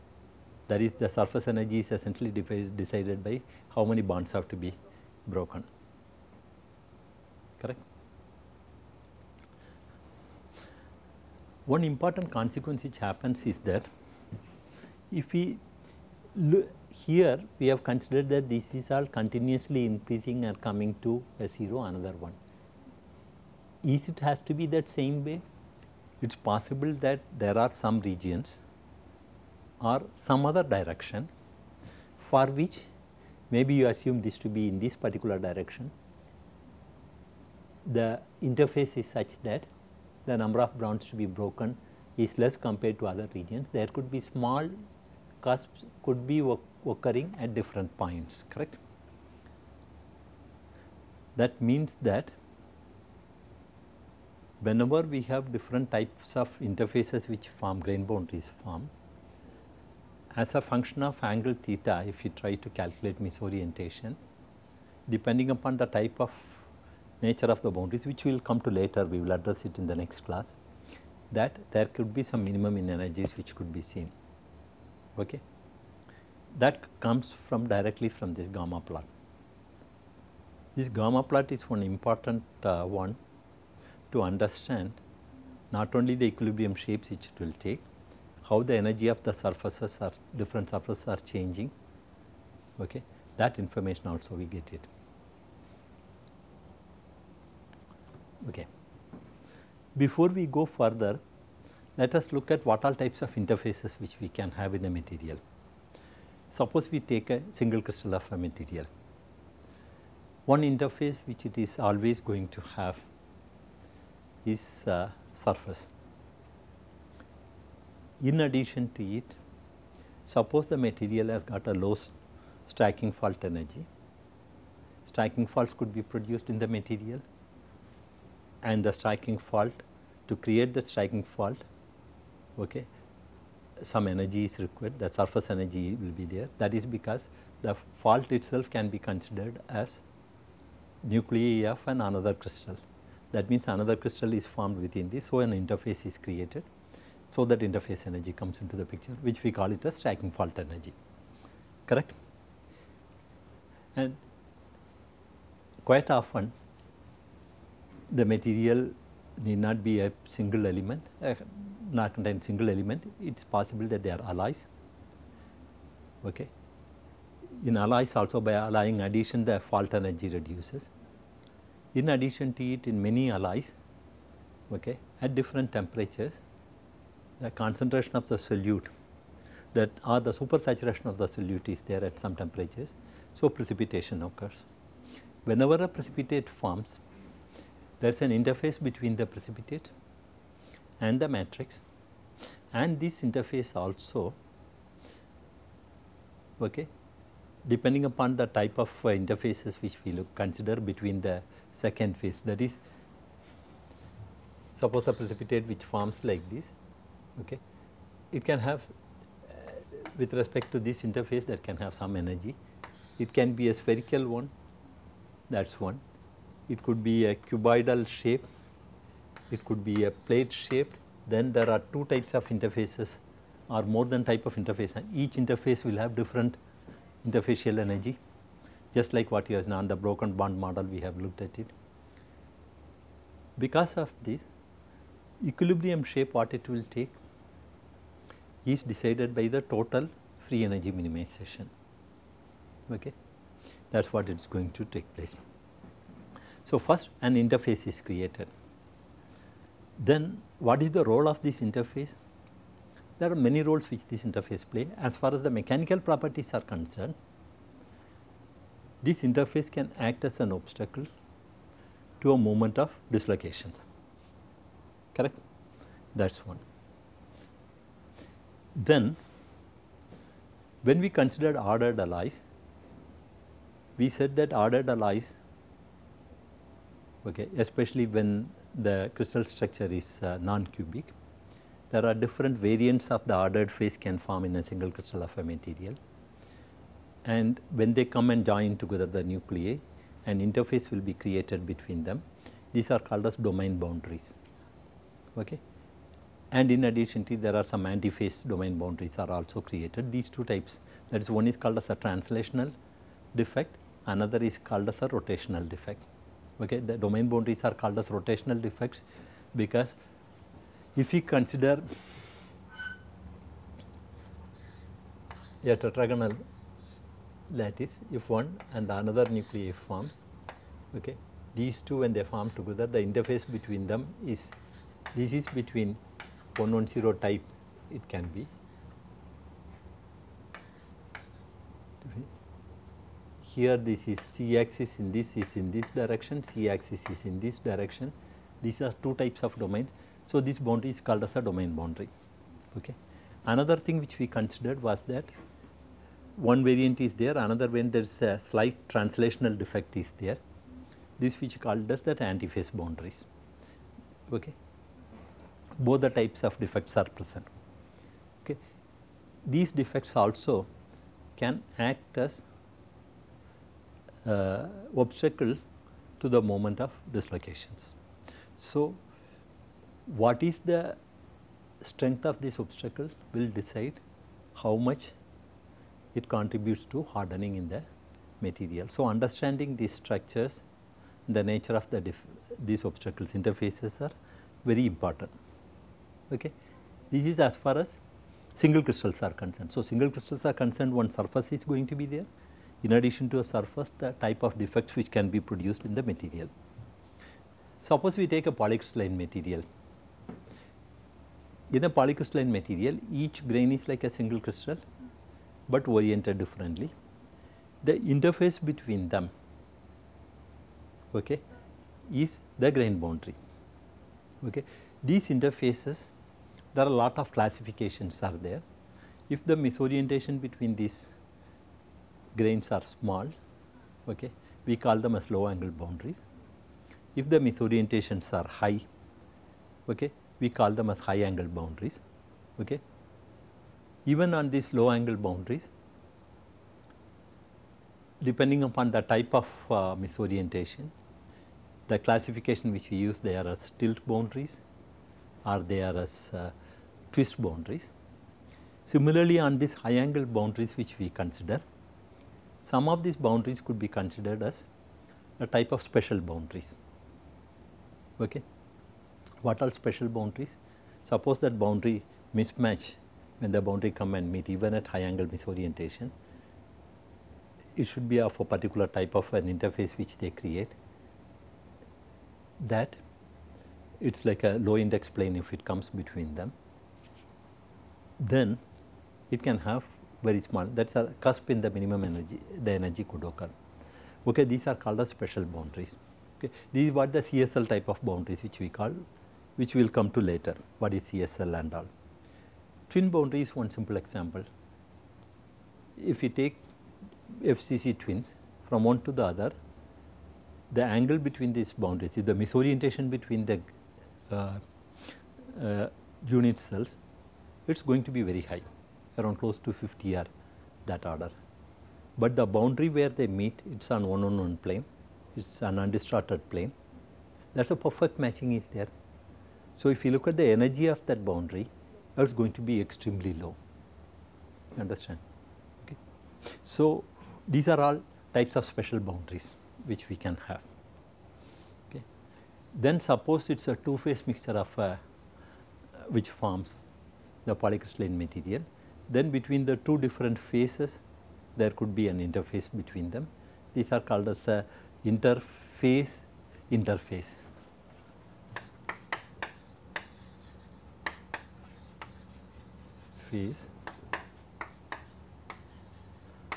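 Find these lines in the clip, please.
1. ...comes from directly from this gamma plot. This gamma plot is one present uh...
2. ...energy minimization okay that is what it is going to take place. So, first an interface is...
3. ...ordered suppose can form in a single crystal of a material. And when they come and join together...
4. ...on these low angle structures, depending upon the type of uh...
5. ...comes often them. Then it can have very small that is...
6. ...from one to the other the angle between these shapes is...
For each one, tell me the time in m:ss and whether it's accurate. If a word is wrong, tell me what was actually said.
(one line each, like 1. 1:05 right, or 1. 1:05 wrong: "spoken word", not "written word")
1. 1:17 wrong: "important", not "present"
2. 4:00 right
3. 4:43 wrong: "phase", not "suppose"
4. 7:14 wrong: "boundaries", not "structures"
5. 7:55 wrong: "between", not "often"
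6. 8:18 wrong: "boundaries", not "shapes".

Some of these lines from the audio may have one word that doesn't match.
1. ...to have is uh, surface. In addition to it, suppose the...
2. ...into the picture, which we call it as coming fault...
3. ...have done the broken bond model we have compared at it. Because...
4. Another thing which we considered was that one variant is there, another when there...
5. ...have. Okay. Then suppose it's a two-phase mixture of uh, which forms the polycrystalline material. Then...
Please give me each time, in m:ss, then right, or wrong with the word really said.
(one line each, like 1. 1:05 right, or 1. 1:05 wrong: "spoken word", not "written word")
1. 1:52 right
2. 2:28 wrong: "stacking", not "coming"
3. 3:49 wrong: "looked", not "compared"
4. 5:43 right
5. 8:50 right.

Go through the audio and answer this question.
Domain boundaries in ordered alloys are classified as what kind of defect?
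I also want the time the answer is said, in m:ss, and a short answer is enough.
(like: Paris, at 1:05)
rotational defects, at 5:08.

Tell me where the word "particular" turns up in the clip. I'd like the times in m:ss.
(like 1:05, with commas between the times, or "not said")
0:34, 7:48.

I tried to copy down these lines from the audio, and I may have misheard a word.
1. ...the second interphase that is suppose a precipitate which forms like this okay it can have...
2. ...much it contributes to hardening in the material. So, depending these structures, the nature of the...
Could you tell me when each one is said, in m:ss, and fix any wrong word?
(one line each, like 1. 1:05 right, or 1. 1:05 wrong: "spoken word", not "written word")
1. 3:21 wrong: "phase", not "interphase"
2. 6:14 wrong: "understanding", not "depending".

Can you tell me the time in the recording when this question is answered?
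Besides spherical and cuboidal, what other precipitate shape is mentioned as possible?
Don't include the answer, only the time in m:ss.
3:40.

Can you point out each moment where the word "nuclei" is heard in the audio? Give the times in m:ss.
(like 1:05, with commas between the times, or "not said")
2:21, 4:49, 5:19.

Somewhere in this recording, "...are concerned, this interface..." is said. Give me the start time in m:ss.
4:16.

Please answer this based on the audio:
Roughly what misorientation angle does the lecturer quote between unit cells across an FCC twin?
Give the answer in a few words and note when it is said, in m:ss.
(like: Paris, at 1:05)
50, at 8:29.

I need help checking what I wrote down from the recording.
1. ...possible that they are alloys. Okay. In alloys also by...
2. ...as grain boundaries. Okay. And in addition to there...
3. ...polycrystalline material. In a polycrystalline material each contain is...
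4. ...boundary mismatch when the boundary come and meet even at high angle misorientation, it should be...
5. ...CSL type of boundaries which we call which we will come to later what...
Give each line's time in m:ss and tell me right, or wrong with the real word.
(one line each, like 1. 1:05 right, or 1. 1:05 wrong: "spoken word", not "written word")
1. 2:43 right
2. 4:53 wrong: "domain", not "grain"
3. 6:38 wrong: "grain", not "contain"
4. 7:41 right
5. 8:07 right.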